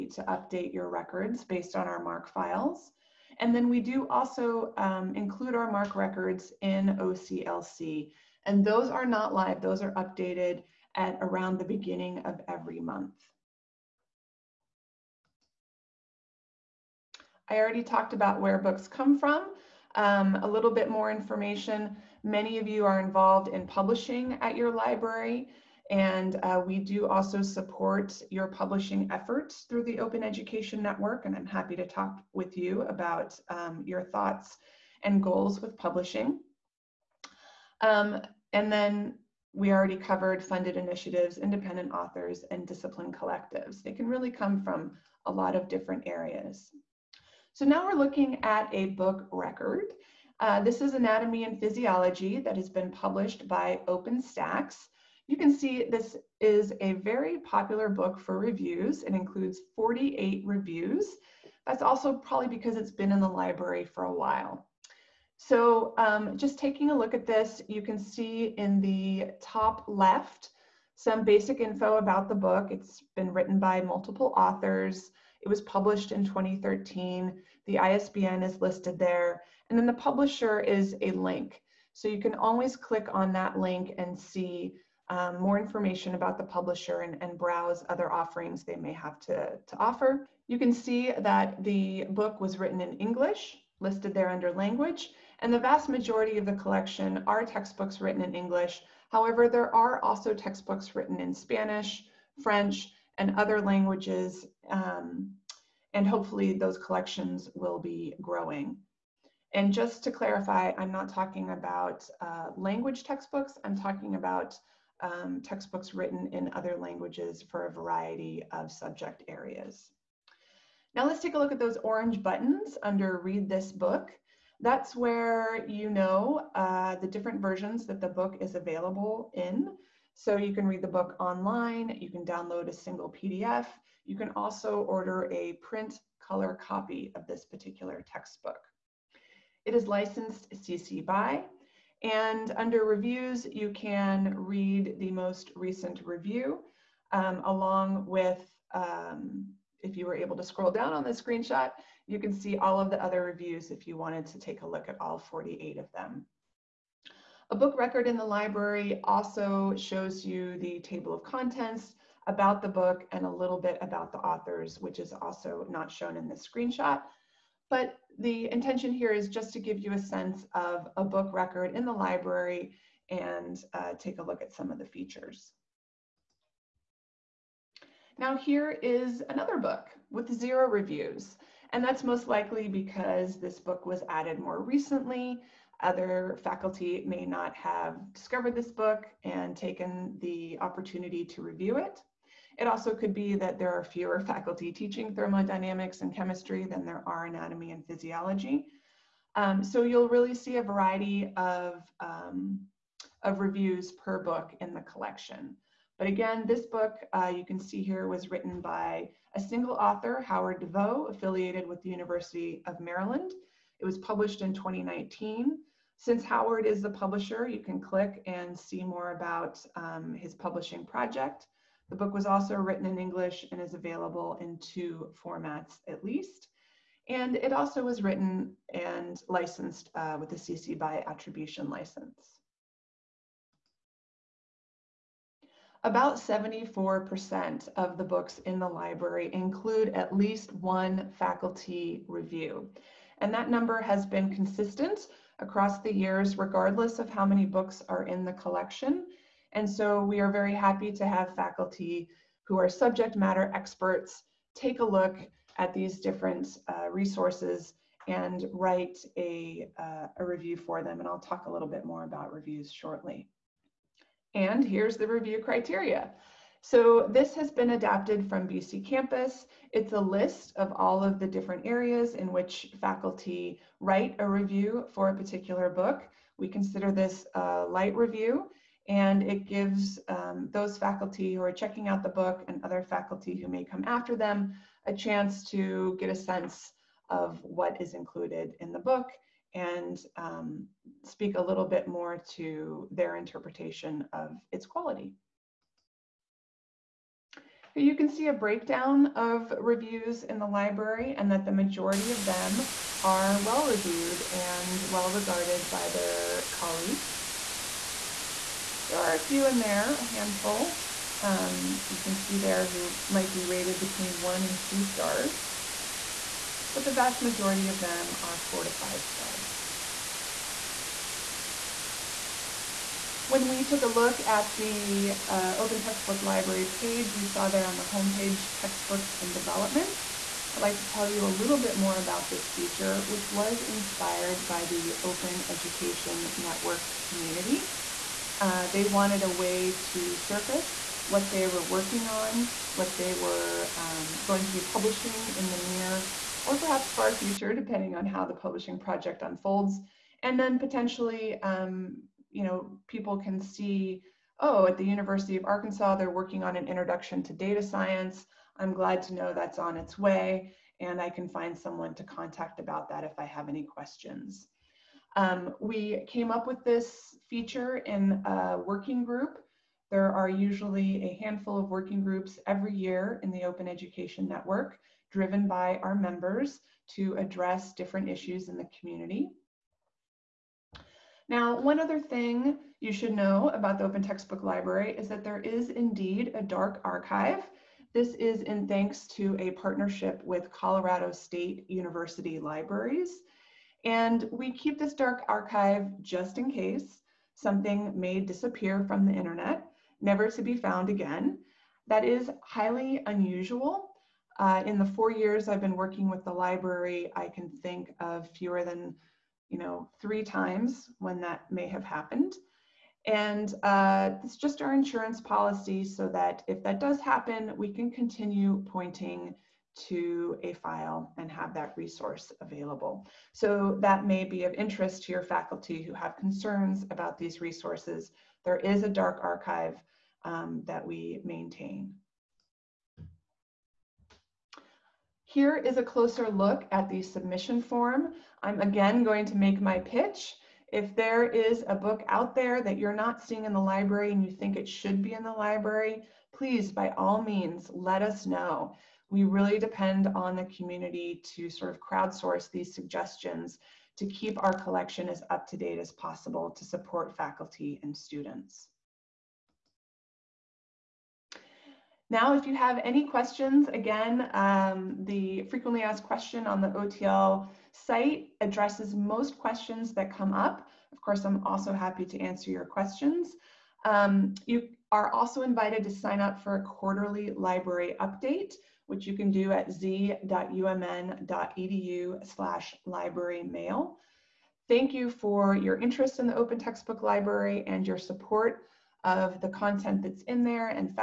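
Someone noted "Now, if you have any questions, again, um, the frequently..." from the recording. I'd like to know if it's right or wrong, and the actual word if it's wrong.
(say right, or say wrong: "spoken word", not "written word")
right.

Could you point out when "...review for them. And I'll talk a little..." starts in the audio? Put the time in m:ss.
4:20.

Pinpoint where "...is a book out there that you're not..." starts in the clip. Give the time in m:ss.
7:21.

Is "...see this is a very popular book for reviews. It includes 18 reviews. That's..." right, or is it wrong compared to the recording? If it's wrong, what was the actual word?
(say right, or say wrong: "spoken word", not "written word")
wrong: "48", not "18".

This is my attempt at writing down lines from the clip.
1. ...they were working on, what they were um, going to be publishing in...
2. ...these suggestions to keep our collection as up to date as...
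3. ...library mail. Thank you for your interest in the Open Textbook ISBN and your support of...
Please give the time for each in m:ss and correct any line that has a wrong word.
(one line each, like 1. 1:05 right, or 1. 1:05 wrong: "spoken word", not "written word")
1. 5:41 right
2. 7:32 right
3. 8:02 wrong: "Library", not "ISBN".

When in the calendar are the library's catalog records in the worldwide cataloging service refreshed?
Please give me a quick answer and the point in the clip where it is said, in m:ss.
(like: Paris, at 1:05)
Beginning of every month, at 0:11.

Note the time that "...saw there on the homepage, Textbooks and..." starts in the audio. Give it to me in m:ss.
5:27.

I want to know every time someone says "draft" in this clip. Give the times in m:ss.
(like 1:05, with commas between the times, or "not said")
not said.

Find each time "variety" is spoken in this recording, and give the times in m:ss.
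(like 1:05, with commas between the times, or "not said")
1:57, 3:20.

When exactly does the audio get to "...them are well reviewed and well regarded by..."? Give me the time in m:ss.
5:02.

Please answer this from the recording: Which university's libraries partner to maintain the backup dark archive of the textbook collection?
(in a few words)
Colorado State University.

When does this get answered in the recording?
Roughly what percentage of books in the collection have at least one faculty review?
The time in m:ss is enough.
3:56.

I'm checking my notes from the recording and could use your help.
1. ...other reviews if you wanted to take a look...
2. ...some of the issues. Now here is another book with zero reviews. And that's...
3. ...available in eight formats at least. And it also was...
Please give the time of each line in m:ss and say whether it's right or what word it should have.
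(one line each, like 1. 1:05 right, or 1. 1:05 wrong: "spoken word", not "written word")
1. 2:33 right
2. 2:54 wrong: "features", not "issues"
3. 3:43 wrong: "two", not "eight".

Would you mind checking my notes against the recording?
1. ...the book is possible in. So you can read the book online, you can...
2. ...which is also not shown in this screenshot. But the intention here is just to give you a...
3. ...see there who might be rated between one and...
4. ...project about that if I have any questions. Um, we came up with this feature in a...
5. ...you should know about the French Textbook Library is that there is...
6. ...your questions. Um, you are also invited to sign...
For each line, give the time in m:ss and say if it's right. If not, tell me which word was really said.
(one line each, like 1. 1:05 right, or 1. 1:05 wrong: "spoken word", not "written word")
1. 2:08 wrong: "available", not "possible"
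2. 2:44 right
3. 5:12 right
4. 6:02 wrong: "contact", not "project"
5. 6:22 wrong: "Open", not "French"
6. 7:52 right.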